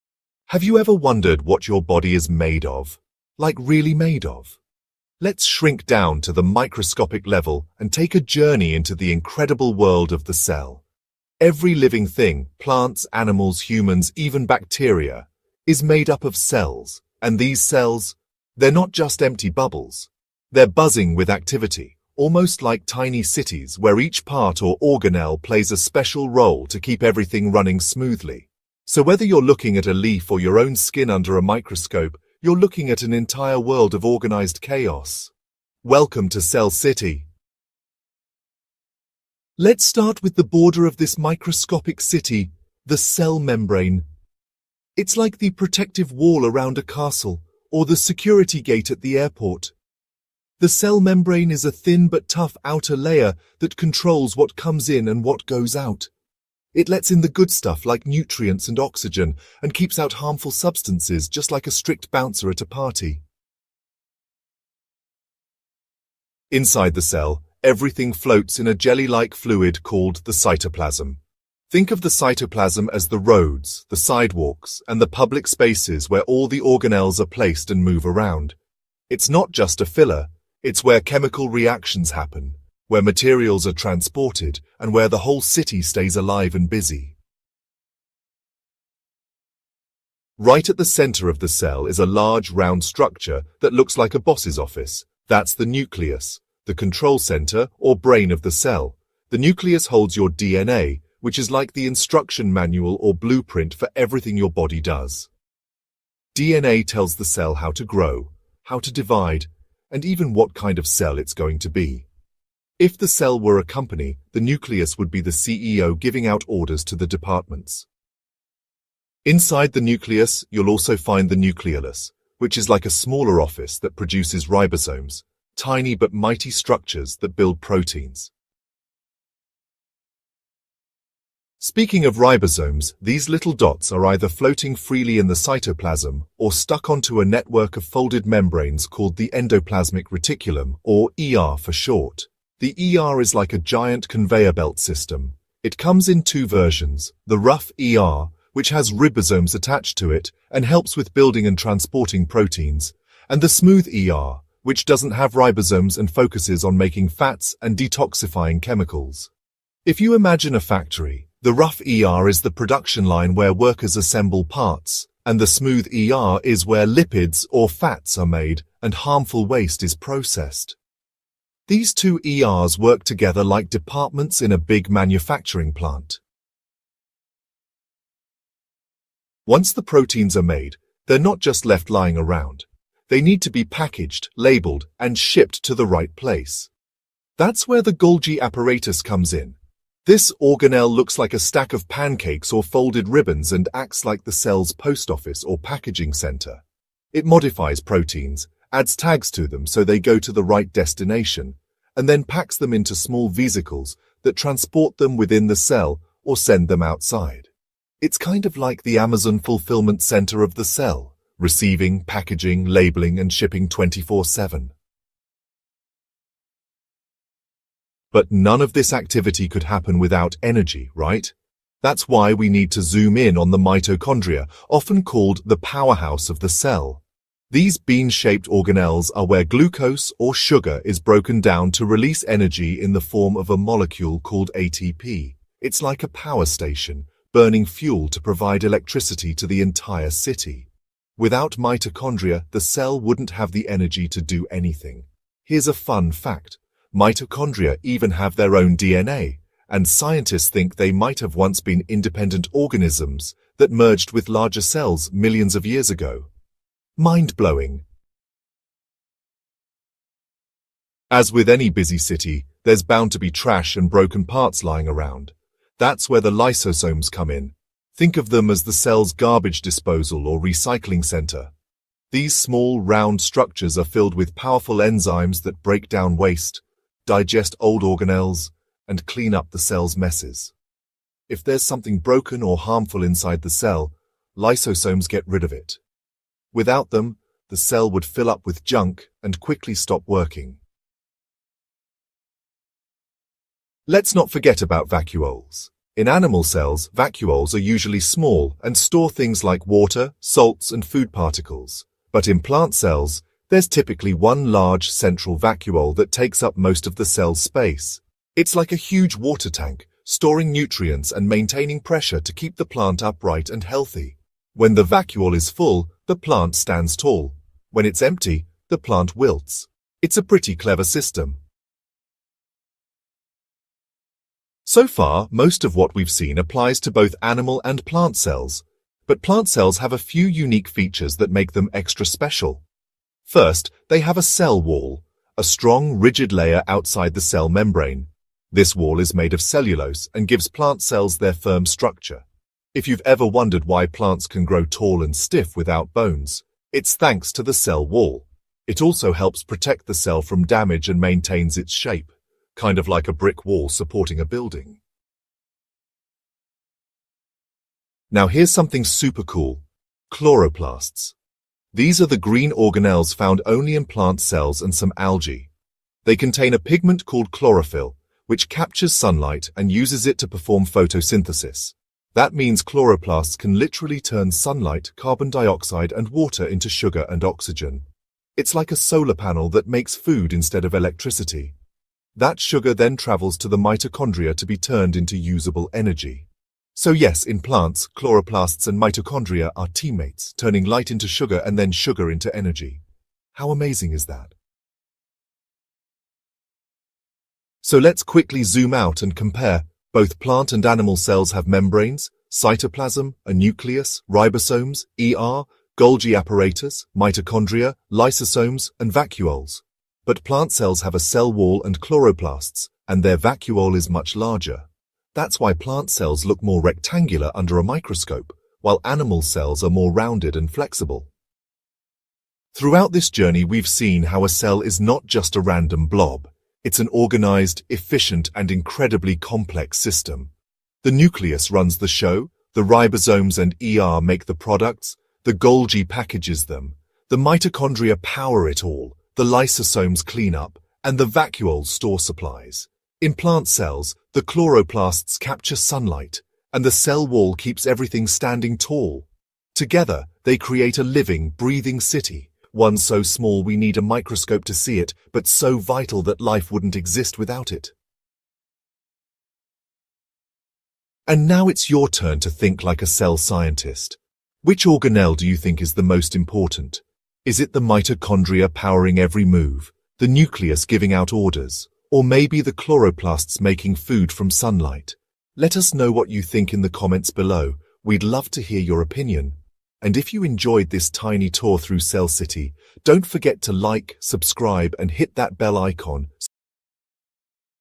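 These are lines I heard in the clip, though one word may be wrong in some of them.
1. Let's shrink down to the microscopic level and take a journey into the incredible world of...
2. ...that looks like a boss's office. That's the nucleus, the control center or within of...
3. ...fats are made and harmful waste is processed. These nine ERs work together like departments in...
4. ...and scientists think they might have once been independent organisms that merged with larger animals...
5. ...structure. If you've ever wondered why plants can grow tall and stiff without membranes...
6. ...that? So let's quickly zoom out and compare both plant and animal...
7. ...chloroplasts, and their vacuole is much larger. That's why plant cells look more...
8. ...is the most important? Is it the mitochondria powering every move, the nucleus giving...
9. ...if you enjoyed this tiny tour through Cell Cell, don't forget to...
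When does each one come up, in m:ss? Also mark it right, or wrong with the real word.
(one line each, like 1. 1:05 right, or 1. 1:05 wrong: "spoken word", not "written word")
1. 0:05 right
2. 1:33 wrong: "brain", not "within"
3. 2:47 wrong: "two", not "nine"
4. 4:09 wrong: "cells", not "animals"
5. 5:41 wrong: "bones", not "membranes"
6. 6:34 right
7. 6:51 right
8. 7:45 right
9. 7:59 wrong: "City", not "Cell".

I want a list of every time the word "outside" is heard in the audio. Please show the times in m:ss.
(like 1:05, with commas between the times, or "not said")
3:26, 5:36.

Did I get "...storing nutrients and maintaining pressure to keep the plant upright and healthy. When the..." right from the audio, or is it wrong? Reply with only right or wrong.
right.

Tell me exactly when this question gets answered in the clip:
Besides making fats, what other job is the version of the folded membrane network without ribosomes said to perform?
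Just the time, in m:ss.
2:37.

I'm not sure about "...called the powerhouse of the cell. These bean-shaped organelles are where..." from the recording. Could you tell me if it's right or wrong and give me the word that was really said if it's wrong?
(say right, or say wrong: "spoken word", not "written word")
right.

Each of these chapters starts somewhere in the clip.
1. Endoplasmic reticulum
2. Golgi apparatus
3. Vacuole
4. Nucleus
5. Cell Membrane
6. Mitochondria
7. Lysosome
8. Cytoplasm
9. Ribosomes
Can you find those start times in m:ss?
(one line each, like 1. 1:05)
1. 2:22
2. 3:03
3. 4:53
4. 1:30
5. 0:40
6. 3:40
7. 4:21
8. 1:06
9. 2:12.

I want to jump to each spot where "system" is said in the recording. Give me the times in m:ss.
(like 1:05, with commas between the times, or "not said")
2:24, 5:20, 7:09.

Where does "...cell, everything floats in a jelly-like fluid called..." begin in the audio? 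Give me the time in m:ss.
1:07.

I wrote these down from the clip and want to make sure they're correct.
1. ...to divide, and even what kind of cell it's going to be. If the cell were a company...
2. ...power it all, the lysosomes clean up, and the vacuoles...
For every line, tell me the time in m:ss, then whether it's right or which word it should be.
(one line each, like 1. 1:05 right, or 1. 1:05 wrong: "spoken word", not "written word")
1. 1:48 right
2. 7:18 right.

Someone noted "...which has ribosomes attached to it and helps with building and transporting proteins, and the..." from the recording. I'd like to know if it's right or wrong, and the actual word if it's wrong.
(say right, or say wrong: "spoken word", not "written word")
right.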